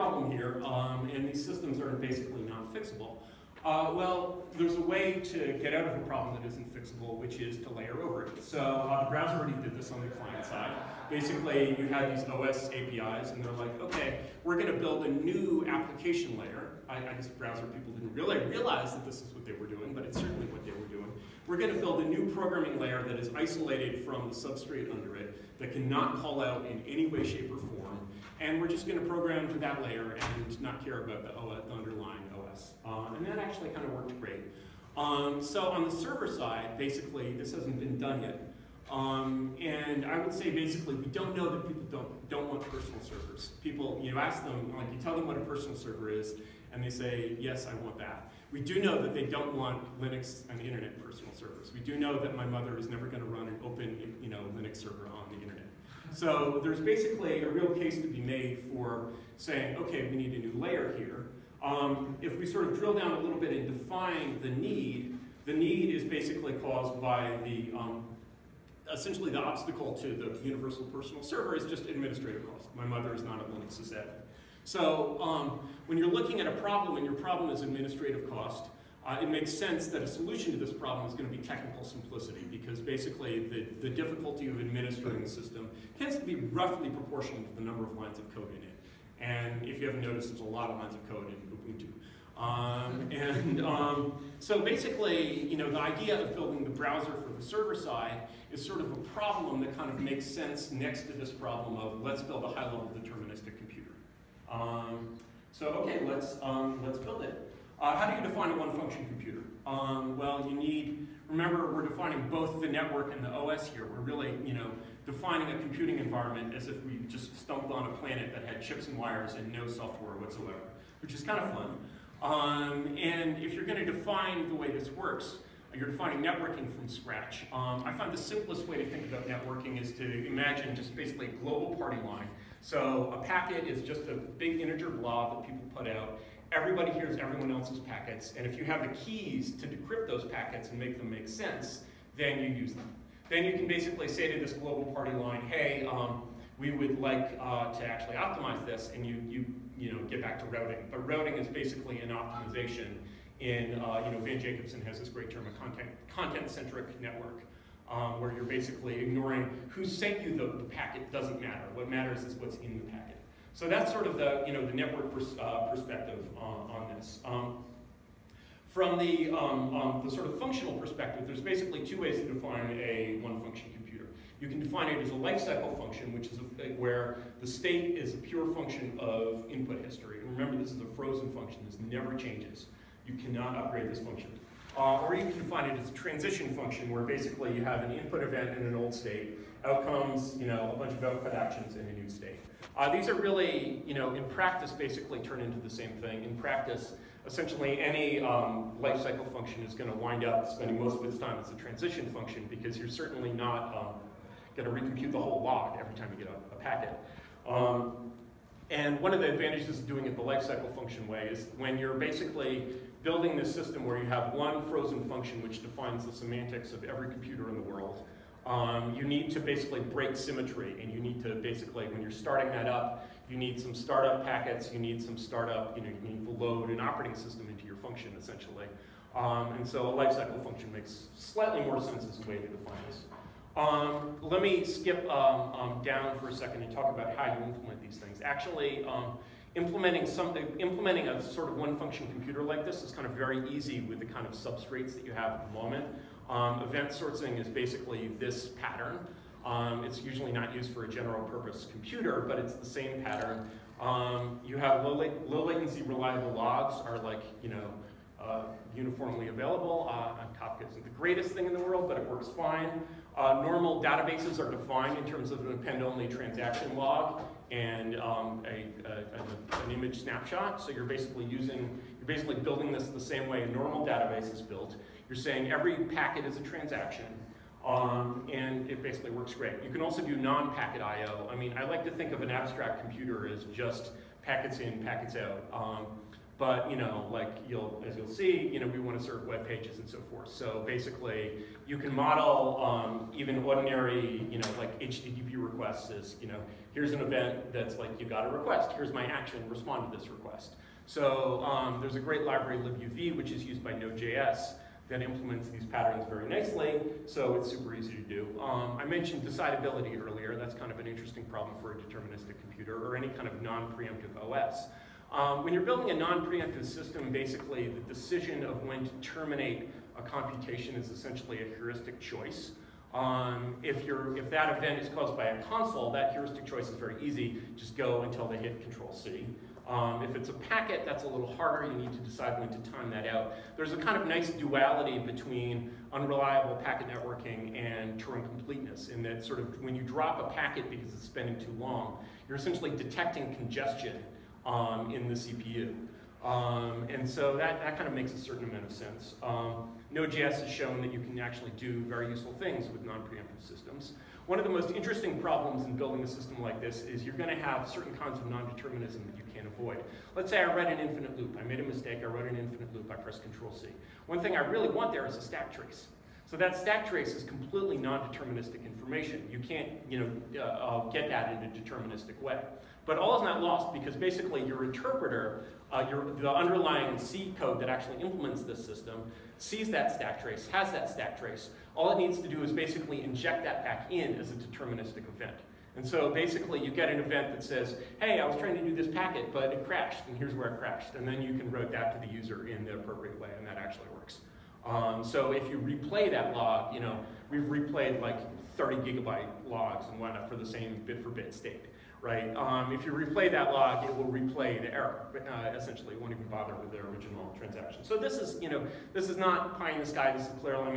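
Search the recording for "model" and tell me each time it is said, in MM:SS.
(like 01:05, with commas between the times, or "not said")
04:51.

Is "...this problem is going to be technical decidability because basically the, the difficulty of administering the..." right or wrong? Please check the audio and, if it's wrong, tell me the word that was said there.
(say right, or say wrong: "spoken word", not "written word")
wrong: "simplicity", not "decidability".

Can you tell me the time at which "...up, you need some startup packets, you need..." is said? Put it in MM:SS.
03:42.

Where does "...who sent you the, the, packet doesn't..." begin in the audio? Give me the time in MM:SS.
02:39.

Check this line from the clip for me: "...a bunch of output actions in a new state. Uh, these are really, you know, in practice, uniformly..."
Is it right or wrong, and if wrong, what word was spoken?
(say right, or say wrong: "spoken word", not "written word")
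wrong: "basically", not "uniformly".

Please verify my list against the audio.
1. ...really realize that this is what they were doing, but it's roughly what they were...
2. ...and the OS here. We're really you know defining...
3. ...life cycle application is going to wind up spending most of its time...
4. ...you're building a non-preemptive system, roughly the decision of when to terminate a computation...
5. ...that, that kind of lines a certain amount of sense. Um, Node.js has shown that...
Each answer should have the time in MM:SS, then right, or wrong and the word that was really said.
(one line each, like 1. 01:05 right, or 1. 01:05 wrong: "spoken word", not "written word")
1. 00:18 wrong: "certainly", not "roughly"
2. 01:53 right
3. 03:18 wrong: "function", not "application"
4. 05:15 wrong: "basically", not "roughly"
5. 05:47 wrong: "makes", not "lines".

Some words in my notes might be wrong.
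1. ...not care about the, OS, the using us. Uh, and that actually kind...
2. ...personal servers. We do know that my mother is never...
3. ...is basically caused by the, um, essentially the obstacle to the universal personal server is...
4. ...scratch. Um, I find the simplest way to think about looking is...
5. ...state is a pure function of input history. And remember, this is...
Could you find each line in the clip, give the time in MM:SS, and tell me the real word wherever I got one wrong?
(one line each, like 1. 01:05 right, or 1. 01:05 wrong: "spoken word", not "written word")
1. 00:30 wrong: "underlying", not "using"
2. 00:51 right
3. 01:05 right
4. 02:06 wrong: "networking", not "looking"
5. 02:57 right.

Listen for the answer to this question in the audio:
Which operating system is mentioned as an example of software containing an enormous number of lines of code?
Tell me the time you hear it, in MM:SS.
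01:31.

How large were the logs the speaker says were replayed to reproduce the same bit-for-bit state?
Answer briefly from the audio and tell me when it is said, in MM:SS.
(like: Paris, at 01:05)
30 gigabytes, at 06:38.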